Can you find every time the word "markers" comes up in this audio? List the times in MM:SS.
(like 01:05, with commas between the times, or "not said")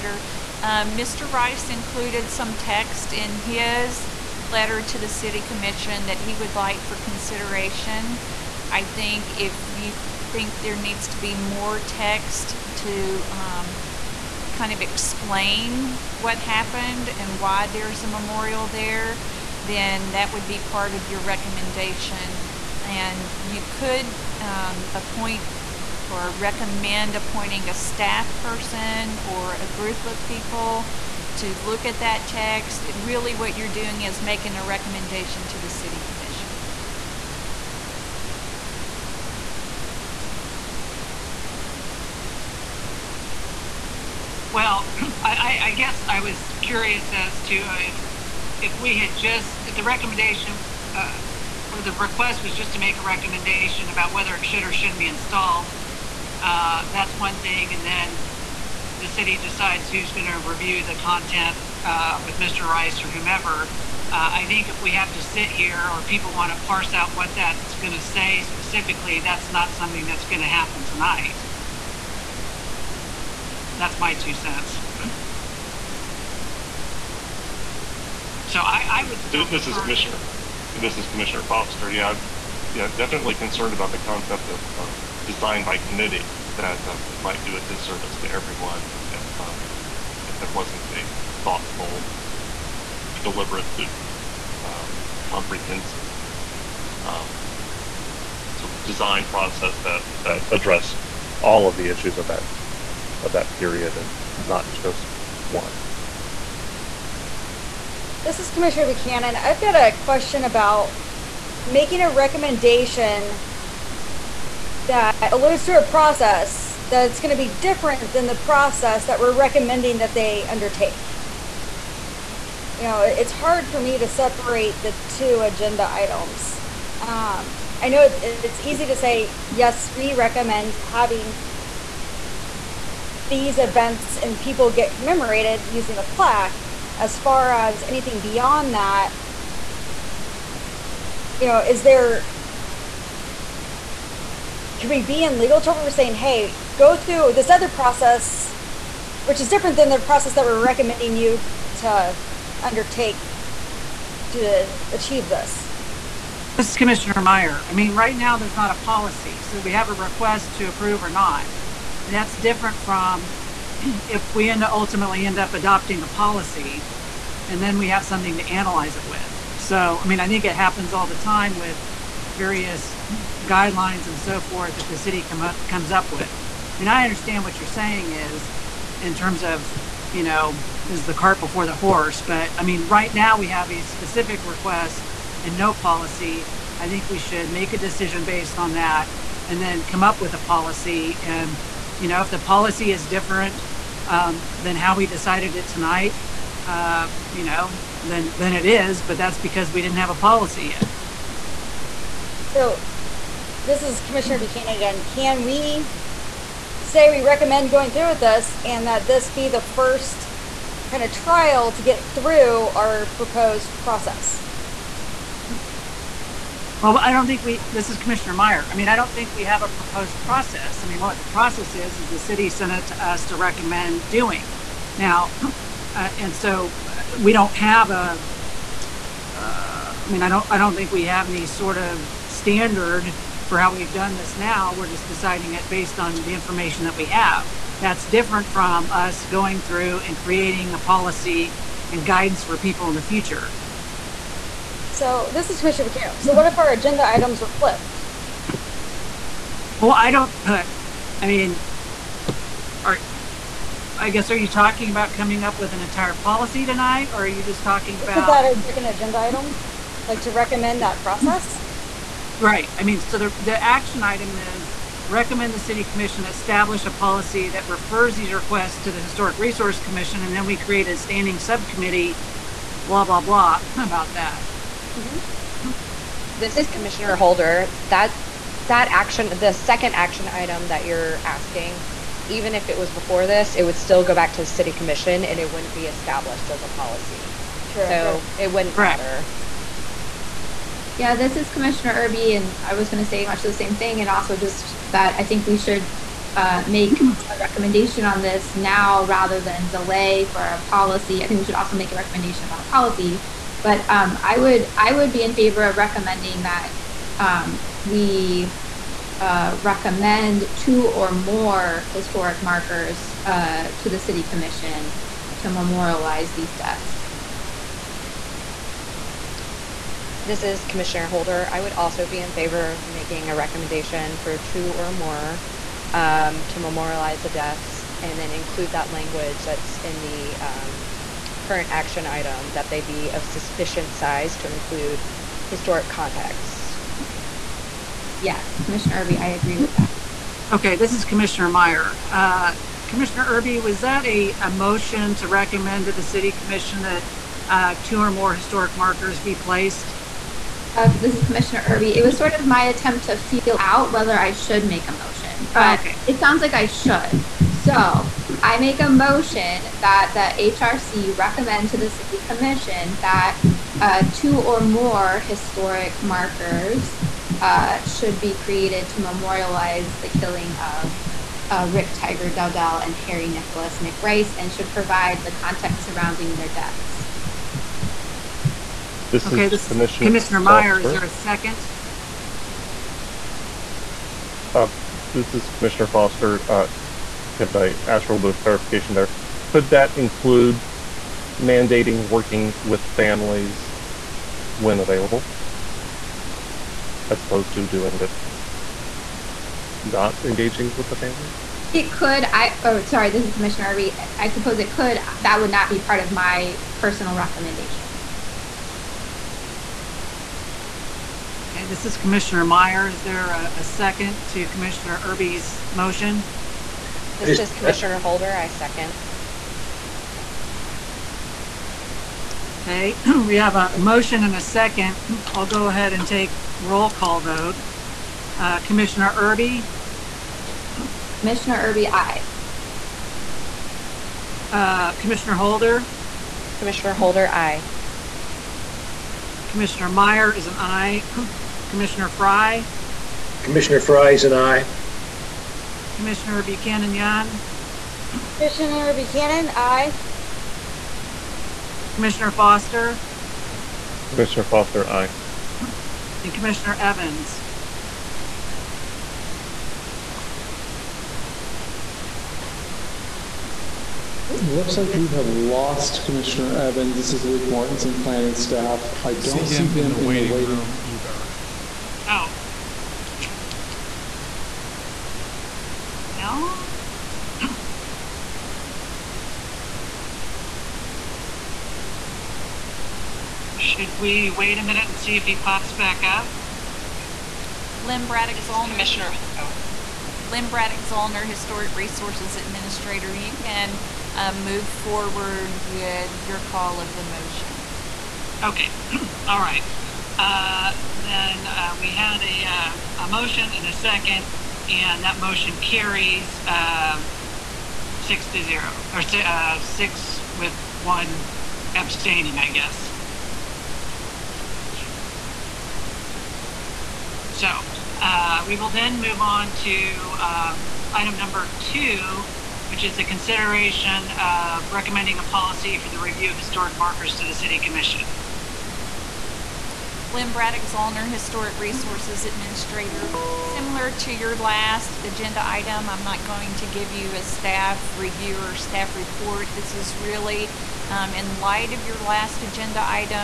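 05:12, 05:48, 06:06, 08:46.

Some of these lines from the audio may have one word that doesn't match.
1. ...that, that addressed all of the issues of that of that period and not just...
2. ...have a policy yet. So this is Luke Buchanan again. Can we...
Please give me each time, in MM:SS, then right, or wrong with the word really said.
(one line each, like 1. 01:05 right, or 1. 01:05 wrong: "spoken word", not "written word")
1. 01:39 right
2. 03:19 wrong: "Commissioner", not "Luke".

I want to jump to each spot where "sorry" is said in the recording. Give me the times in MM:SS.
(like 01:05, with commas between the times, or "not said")
06:42, 07:00.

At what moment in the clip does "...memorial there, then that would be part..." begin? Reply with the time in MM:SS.
00:18.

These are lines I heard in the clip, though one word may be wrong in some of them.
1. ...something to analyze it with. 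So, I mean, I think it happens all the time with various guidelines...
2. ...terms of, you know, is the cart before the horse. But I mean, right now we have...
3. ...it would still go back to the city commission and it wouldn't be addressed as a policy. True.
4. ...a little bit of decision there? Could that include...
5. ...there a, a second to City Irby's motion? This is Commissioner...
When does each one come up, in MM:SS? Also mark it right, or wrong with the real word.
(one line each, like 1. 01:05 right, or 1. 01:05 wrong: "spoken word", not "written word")
1. 02:48 right
2. 02:59 right
3. 04:43 wrong: "established", not "addressed"
4. 06:28 wrong: "clarification", not "decision"
5. 06:53 wrong: "Commissioner", not "City".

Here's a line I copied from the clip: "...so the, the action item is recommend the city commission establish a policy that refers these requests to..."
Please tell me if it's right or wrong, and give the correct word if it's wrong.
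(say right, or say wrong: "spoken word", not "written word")
right.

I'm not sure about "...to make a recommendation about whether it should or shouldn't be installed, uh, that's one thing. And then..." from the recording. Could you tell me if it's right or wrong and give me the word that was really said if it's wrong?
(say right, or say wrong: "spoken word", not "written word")
right.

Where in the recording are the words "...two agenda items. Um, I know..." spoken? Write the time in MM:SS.
02:05.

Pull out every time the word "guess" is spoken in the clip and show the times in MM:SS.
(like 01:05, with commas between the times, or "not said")
00:45, 04:14, 08:32.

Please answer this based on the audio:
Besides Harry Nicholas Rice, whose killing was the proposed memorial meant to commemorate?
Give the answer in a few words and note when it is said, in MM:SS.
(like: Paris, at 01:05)
Rick Tiger Dowdell, at 06:11.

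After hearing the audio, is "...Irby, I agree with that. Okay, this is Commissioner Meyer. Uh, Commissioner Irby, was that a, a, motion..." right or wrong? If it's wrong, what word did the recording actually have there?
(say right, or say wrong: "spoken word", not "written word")
right.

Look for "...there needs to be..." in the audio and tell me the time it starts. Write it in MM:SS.
00:10.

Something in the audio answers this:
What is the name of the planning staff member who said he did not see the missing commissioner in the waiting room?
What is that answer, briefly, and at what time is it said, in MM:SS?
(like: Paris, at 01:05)
Luke Mortensen, at 07:47.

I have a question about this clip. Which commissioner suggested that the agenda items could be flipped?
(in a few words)
McCann.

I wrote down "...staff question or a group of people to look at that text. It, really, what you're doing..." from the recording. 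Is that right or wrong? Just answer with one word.
wrong.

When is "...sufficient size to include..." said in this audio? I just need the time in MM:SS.
05:33.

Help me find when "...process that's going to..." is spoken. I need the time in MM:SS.
01:55.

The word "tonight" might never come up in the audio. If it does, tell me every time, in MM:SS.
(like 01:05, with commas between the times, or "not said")
01:10, 03:15, 04:16.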